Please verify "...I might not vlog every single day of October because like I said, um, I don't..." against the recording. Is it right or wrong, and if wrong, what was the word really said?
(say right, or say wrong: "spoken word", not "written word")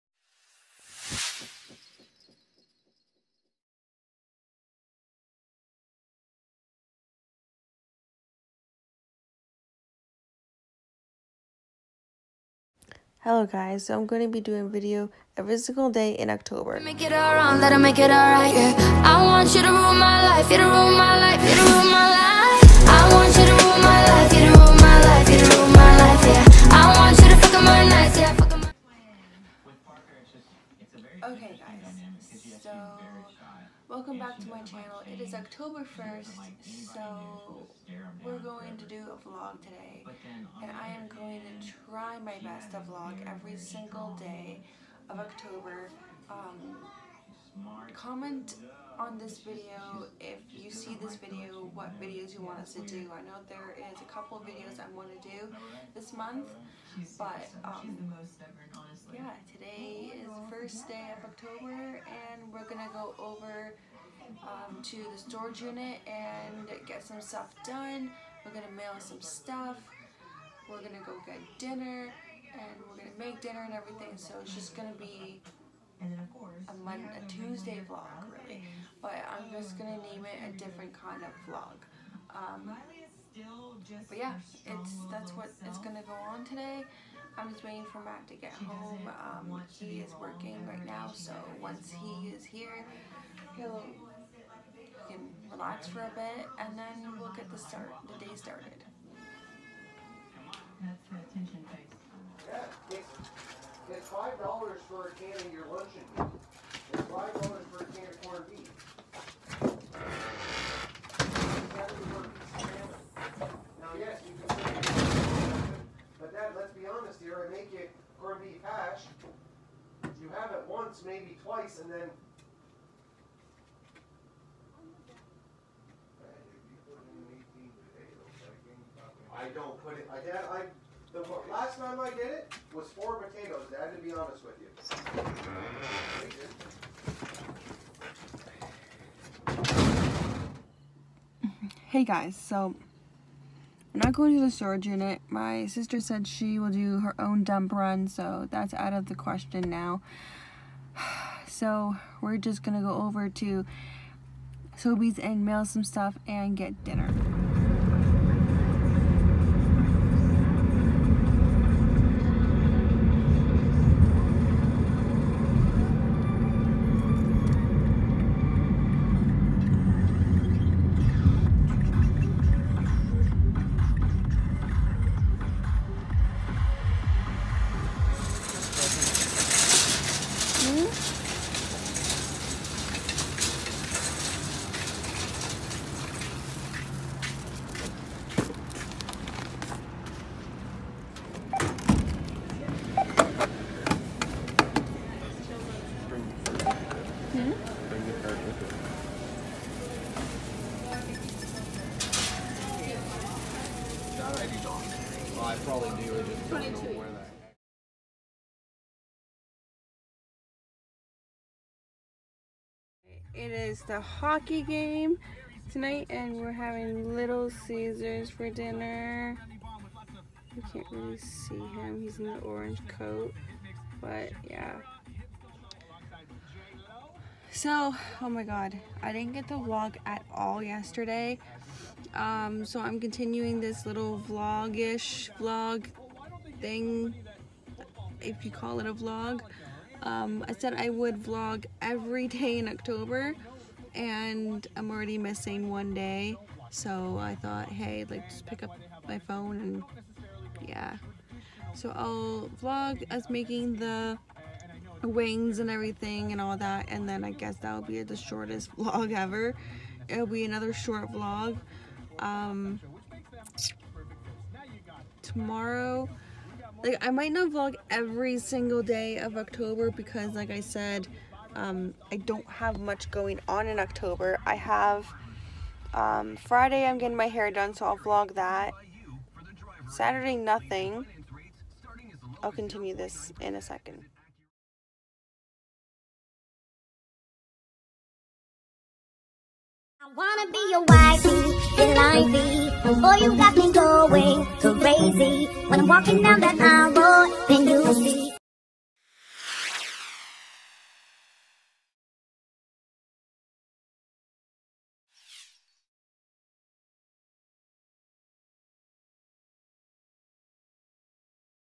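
right.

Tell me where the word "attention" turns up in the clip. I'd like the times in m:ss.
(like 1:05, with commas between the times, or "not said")
1:41.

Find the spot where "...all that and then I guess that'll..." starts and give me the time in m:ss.
4:16.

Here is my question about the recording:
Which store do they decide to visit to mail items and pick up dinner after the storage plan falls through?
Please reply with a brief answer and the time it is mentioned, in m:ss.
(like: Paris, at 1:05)
Sobeys, at 2:34.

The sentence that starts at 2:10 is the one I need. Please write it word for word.
I, I the last time I did it was four potatoes, Dad, to be honest with you.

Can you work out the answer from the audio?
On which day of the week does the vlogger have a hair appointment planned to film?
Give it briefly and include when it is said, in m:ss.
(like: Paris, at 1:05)
Friday, at 4:36.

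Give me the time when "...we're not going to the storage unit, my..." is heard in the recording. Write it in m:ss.
2:23.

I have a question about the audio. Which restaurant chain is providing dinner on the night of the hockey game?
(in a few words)
Little Caesars.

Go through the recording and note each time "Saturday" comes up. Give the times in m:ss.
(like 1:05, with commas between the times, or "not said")
4:39.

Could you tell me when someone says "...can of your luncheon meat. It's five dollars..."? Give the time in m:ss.
1:45.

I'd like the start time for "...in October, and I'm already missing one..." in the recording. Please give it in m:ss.
4:02.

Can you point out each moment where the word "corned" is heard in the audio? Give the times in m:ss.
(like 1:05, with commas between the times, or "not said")
1:48, 1:58.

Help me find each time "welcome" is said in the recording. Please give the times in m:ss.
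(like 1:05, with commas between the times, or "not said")
0:33.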